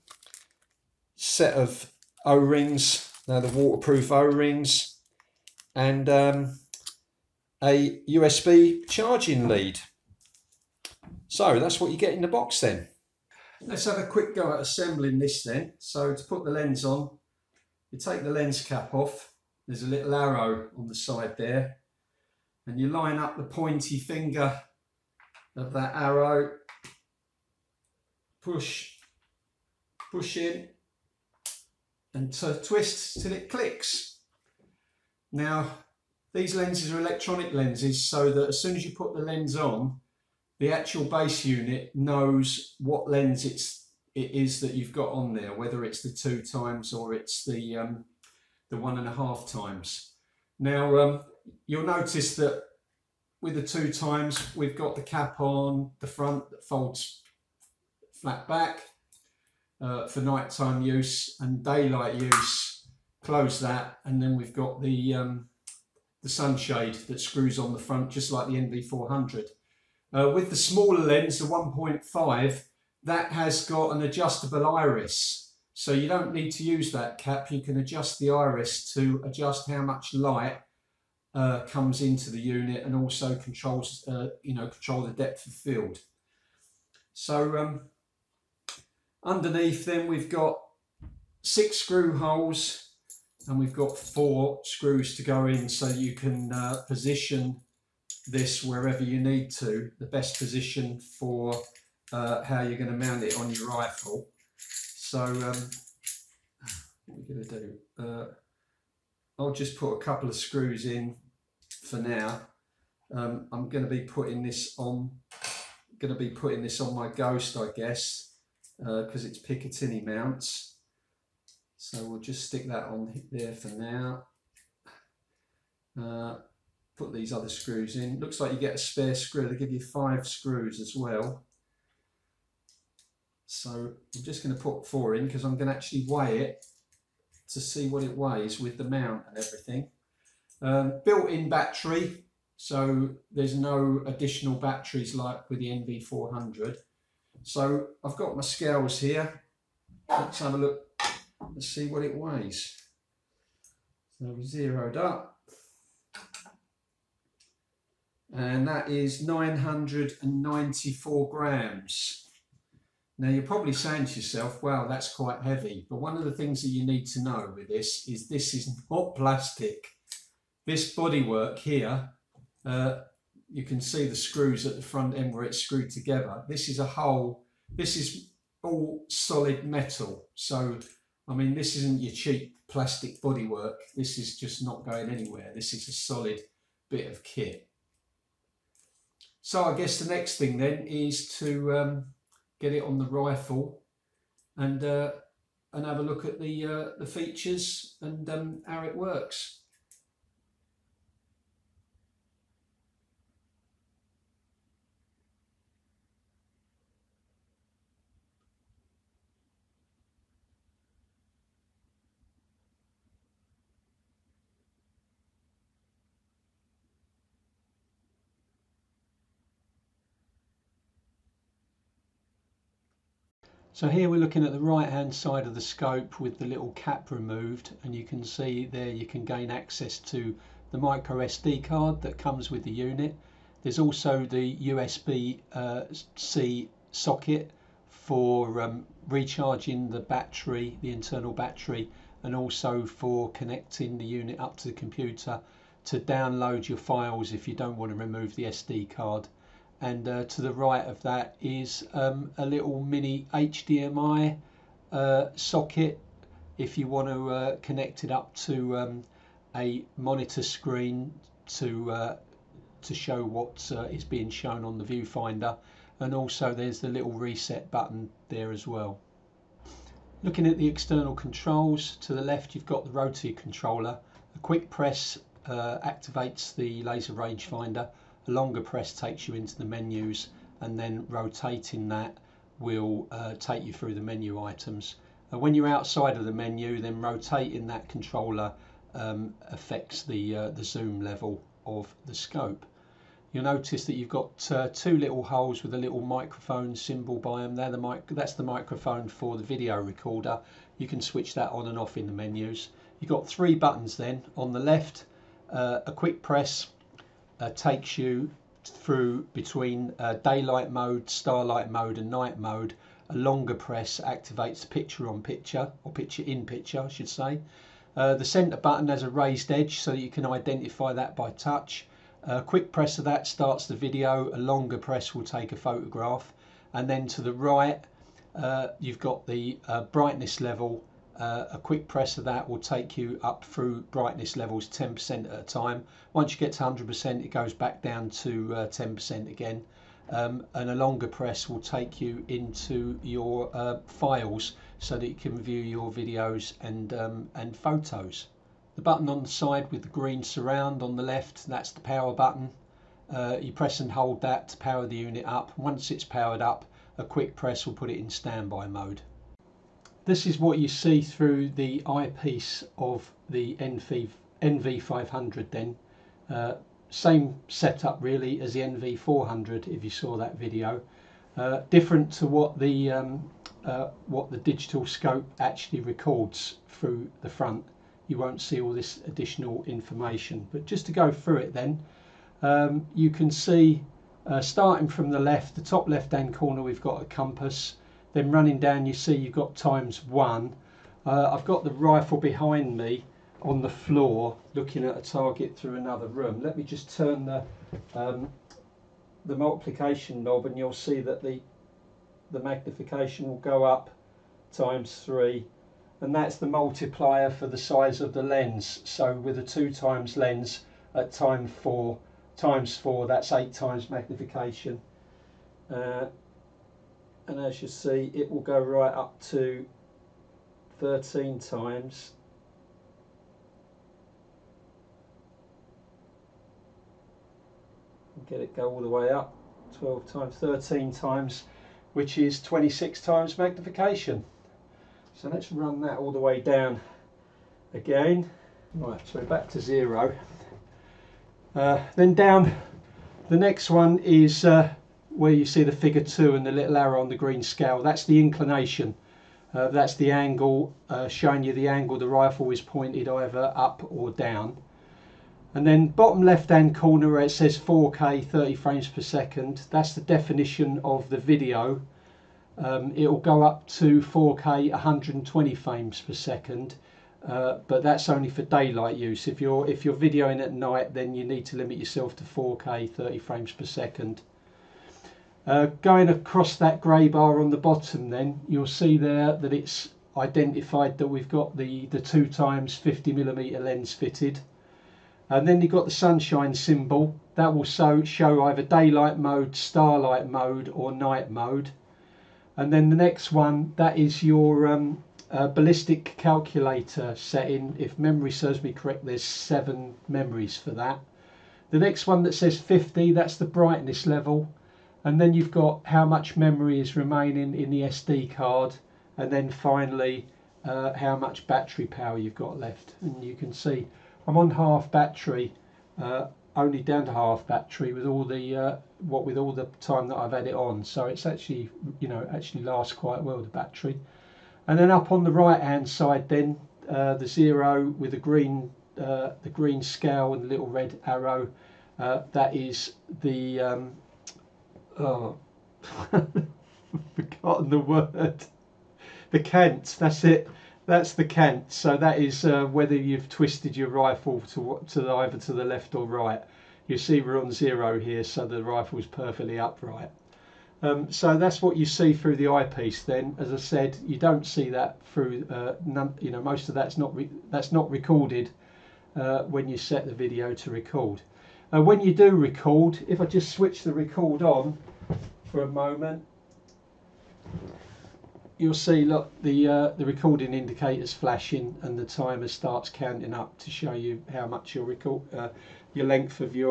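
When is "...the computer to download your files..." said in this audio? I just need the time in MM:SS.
04:04.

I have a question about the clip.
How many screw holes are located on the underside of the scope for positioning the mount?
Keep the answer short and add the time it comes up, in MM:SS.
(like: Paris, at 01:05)
6, at 01:31.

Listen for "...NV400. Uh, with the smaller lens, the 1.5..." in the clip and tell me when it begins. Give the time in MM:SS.
01:08.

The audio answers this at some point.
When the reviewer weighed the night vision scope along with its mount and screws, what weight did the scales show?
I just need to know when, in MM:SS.
02:39.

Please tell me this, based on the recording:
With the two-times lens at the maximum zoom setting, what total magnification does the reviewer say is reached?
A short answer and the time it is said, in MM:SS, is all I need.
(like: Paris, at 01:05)
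26 times, at 07:12.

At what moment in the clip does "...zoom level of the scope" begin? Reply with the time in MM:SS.
04:50.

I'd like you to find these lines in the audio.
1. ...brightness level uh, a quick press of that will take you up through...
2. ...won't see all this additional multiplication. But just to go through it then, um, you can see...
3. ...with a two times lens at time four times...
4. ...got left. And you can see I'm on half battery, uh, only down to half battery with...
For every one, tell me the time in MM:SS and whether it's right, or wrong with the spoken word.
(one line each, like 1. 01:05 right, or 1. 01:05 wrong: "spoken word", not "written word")
1. 05:29 right
2. 06:18 wrong: "information", not "multiplication"
3. 06:49 right
4. 08:32 right.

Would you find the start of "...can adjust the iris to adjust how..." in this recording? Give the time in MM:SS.
01:17.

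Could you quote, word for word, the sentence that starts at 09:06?
You see we're on zero here, so the rifle's perfectly upright.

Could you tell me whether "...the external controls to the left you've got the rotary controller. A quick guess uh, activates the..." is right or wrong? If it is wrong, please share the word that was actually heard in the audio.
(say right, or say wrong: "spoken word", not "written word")
wrong: "press", not "guess".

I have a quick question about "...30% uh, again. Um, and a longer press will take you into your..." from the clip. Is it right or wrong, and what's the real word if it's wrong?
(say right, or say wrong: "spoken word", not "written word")
wrong: "10", not "30".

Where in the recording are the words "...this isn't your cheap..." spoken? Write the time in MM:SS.
03:01.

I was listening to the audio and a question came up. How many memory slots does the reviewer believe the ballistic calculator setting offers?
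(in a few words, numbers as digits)
7.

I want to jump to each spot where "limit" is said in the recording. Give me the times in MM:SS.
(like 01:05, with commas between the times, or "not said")
07:51.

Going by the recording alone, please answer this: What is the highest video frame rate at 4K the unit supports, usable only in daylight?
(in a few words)
120 frames per second.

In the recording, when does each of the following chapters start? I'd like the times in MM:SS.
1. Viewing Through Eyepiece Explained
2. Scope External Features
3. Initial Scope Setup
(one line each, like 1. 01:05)
1. 05:59
2. 03:20
3. 00:12.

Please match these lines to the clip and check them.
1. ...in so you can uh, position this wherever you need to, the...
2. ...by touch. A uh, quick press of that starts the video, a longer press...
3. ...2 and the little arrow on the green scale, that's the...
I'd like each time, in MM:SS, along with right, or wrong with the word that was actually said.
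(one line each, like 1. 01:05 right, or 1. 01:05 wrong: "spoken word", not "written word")
1. 01:35 right
2. 05:21 right
3. 07:26 right.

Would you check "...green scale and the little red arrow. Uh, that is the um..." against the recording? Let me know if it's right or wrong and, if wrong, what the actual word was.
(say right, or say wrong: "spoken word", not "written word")
right.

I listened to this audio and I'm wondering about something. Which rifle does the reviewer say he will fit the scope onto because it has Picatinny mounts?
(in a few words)
Ghost.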